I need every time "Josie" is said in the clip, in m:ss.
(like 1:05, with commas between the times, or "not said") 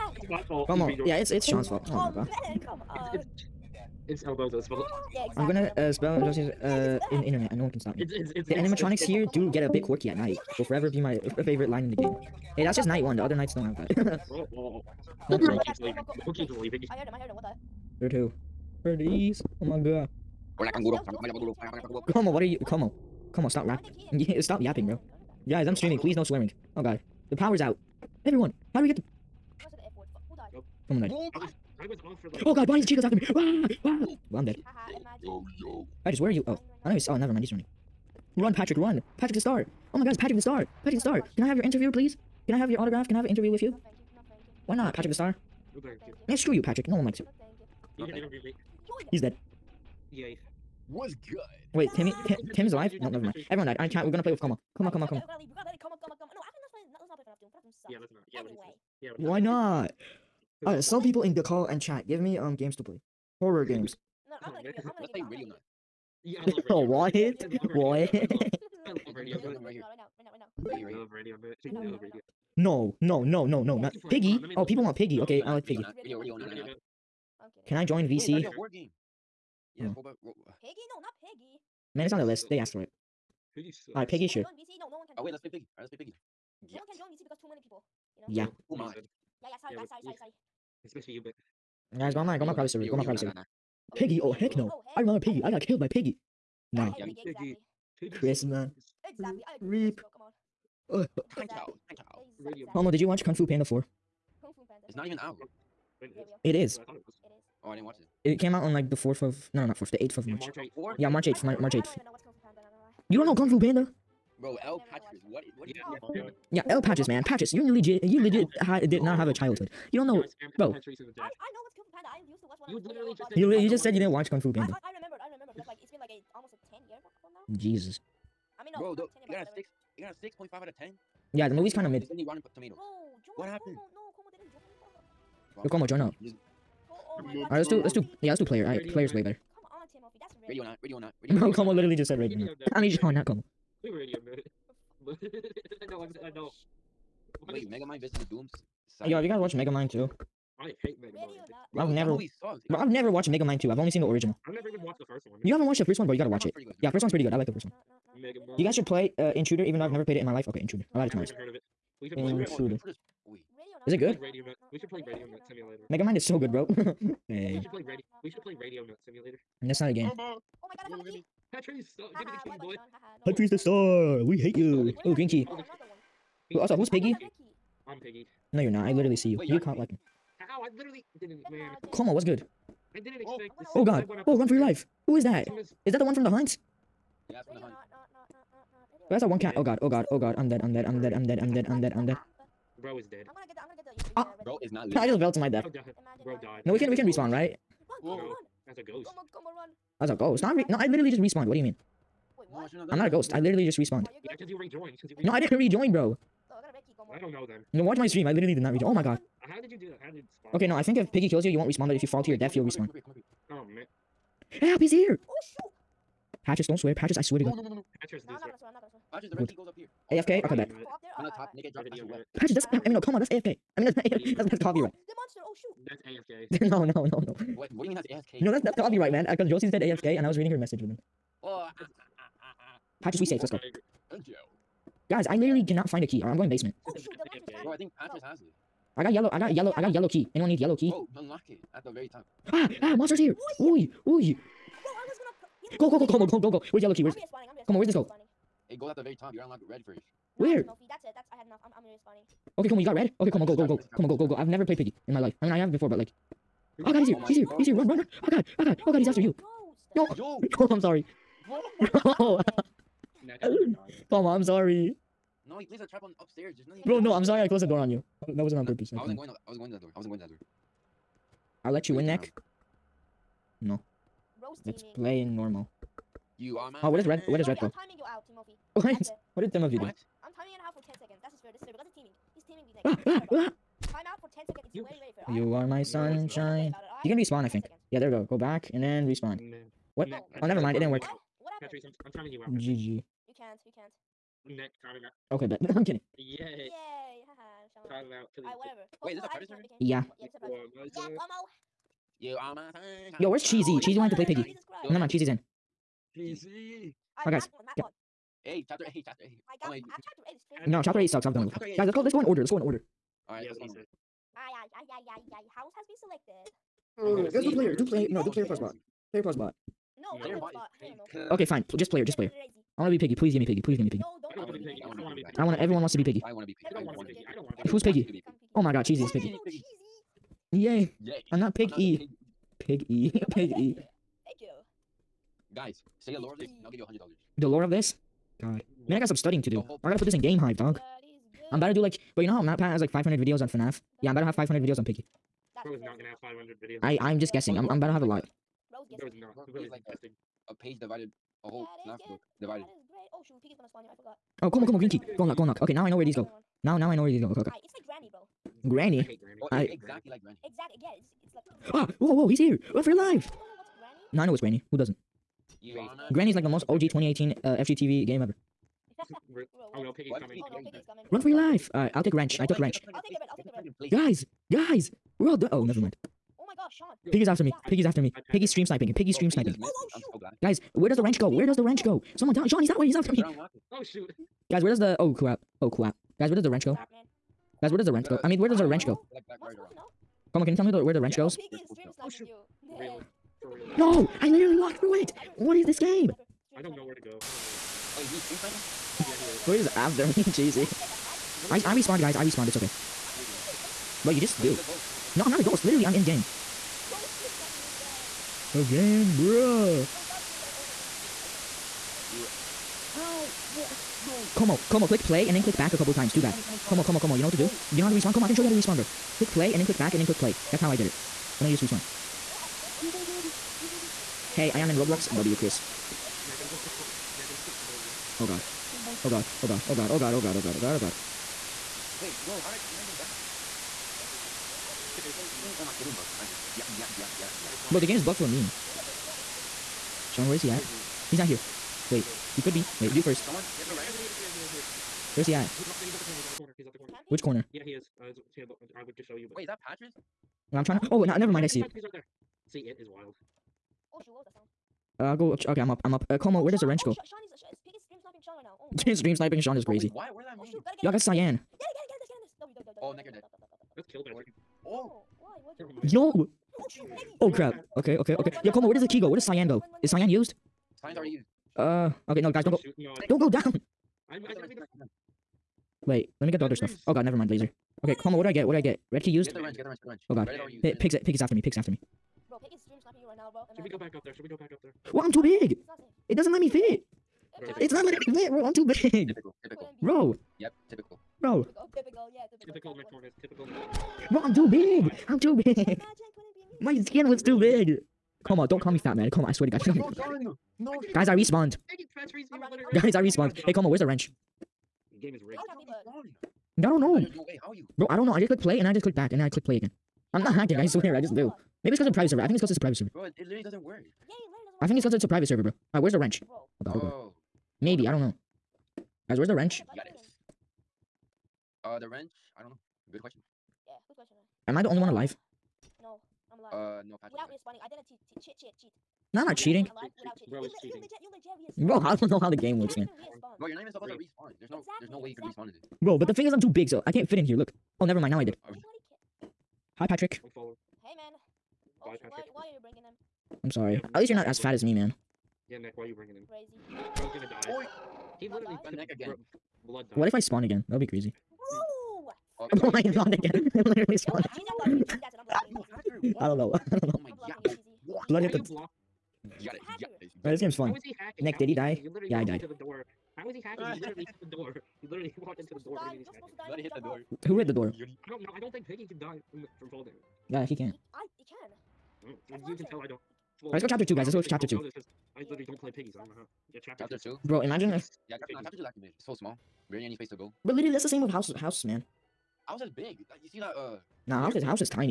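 0:06, 3:49.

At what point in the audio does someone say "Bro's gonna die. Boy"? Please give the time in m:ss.
9:06.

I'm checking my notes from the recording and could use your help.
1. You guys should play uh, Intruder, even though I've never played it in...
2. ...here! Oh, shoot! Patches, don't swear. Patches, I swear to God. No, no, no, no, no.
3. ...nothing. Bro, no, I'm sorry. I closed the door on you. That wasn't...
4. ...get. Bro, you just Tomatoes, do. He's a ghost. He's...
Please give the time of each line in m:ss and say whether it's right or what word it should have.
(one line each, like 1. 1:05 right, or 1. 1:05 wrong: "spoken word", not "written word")
1. 2:38 right
2. 3:34 right
3. 4:26 right
4. 6:43 wrong: "Wait", not "Tomatoes".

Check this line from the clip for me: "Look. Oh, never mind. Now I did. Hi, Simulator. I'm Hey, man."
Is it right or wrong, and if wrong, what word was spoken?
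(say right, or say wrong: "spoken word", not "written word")
wrong: "Patrick", not "Simulator".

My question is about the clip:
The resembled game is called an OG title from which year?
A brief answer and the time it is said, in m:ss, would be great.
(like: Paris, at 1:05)
2018, at 6:06.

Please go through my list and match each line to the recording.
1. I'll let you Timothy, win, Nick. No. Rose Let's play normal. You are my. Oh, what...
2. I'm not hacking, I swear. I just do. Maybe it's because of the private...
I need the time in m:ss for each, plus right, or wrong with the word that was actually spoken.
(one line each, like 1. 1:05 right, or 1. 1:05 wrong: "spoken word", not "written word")
1. 4:31 wrong: "Wait", not "Timothy"
2. 8:30 right.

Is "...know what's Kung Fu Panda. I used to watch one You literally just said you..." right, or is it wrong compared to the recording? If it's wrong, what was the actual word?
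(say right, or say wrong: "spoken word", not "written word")
right.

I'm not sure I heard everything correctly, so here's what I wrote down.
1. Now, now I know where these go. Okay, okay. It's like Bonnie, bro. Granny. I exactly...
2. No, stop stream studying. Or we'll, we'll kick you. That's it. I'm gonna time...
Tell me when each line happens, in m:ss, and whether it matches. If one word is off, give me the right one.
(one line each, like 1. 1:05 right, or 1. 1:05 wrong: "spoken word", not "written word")
1. 5:56 wrong: "Granny", not "Bonnie"
2. 6:49 wrong: "sniping", not "studying".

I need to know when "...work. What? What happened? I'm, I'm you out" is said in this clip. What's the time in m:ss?
4:50.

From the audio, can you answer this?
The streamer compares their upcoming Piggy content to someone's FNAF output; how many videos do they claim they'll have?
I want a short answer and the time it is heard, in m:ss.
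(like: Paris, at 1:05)
500, at 5:44.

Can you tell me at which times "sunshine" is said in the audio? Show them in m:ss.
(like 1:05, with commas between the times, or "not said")
4:45, 5:02.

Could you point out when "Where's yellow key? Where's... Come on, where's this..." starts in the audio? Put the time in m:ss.
4:06.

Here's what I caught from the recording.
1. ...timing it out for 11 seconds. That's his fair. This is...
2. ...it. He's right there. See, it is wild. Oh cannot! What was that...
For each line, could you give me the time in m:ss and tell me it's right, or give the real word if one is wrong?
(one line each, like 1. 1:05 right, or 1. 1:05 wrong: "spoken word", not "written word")
1. 4:40 wrong: "10", not "11"
2. 7:31 wrong: "shoot", not "cannot".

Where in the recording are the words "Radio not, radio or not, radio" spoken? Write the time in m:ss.
2:20.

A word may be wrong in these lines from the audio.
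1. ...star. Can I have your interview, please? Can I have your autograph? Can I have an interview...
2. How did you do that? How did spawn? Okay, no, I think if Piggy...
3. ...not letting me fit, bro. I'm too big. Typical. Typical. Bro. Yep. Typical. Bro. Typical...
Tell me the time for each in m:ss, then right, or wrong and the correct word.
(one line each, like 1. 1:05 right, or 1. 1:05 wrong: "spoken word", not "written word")
1. 0:40 right
2. 3:29 right
3. 8:07 right.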